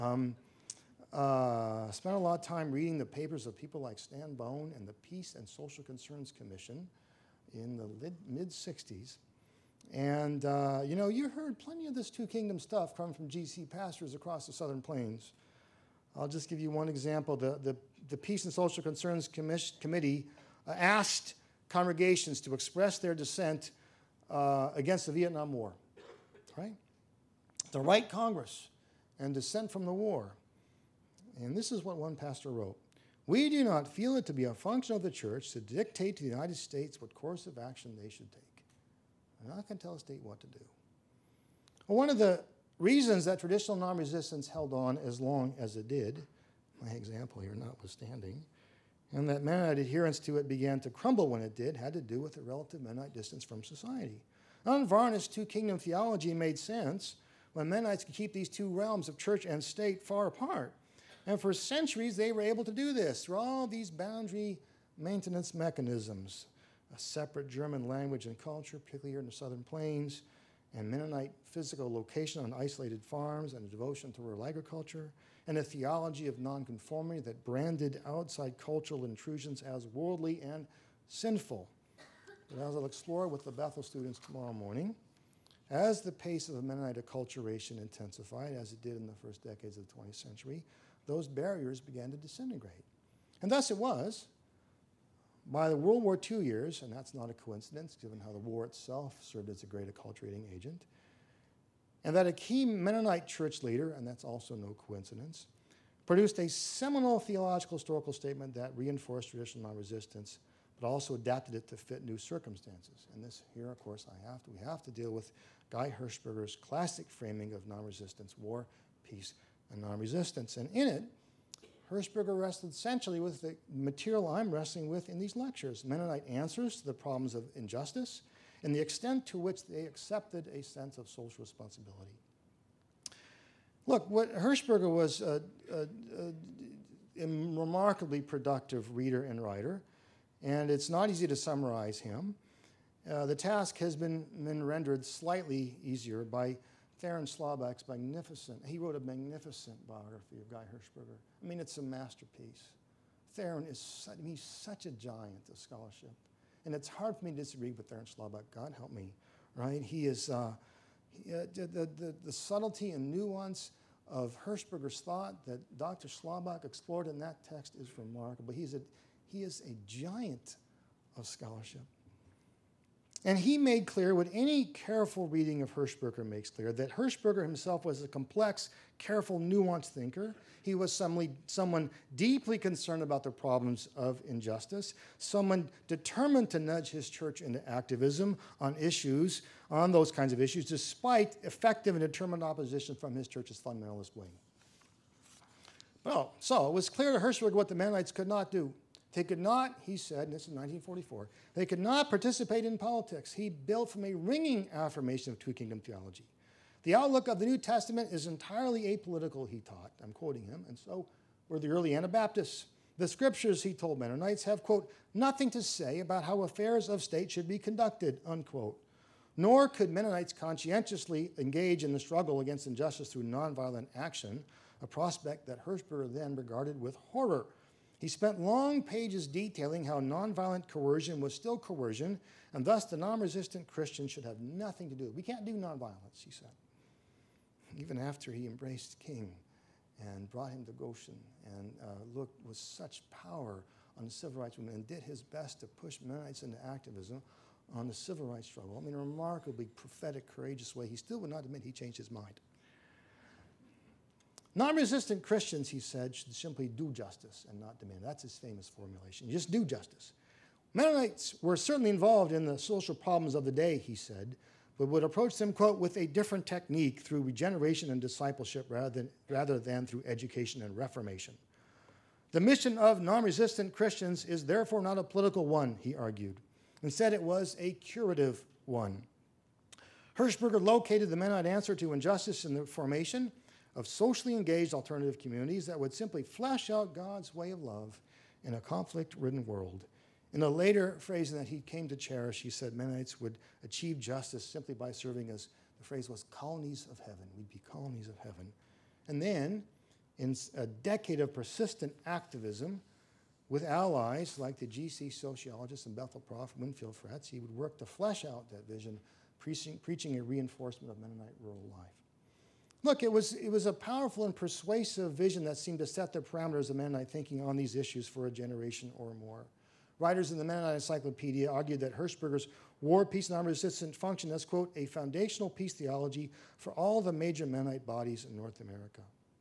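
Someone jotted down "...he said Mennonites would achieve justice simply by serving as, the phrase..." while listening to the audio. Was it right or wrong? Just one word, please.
right.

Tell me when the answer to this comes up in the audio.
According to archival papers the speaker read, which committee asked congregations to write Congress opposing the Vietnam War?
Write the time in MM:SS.
00:18.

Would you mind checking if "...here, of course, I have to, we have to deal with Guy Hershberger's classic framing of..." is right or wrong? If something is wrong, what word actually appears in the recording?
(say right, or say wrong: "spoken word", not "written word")
right.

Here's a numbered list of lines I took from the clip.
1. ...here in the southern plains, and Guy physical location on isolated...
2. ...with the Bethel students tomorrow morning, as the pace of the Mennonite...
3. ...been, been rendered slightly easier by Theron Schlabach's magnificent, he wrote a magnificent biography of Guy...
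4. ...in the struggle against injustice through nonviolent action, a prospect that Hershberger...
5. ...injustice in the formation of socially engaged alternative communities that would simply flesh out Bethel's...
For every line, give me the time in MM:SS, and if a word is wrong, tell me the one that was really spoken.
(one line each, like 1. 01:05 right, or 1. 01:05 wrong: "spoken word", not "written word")
1. 01:09 wrong: "Mennonite", not "Guy"
2. 01:23 right
3. 02:23 right
4. 03:41 right
5. 04:41 wrong: "God", not "Bethel".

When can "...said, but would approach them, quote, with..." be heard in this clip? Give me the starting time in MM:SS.
04:23.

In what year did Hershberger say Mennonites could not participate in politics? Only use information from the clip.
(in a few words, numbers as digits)
1944.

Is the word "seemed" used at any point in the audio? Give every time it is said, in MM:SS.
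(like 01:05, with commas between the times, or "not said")
05:15.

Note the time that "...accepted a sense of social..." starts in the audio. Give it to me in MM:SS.
02:09.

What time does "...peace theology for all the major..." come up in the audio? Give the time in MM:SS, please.
05:25.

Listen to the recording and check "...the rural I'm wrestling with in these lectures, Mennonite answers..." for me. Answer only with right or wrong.
wrong.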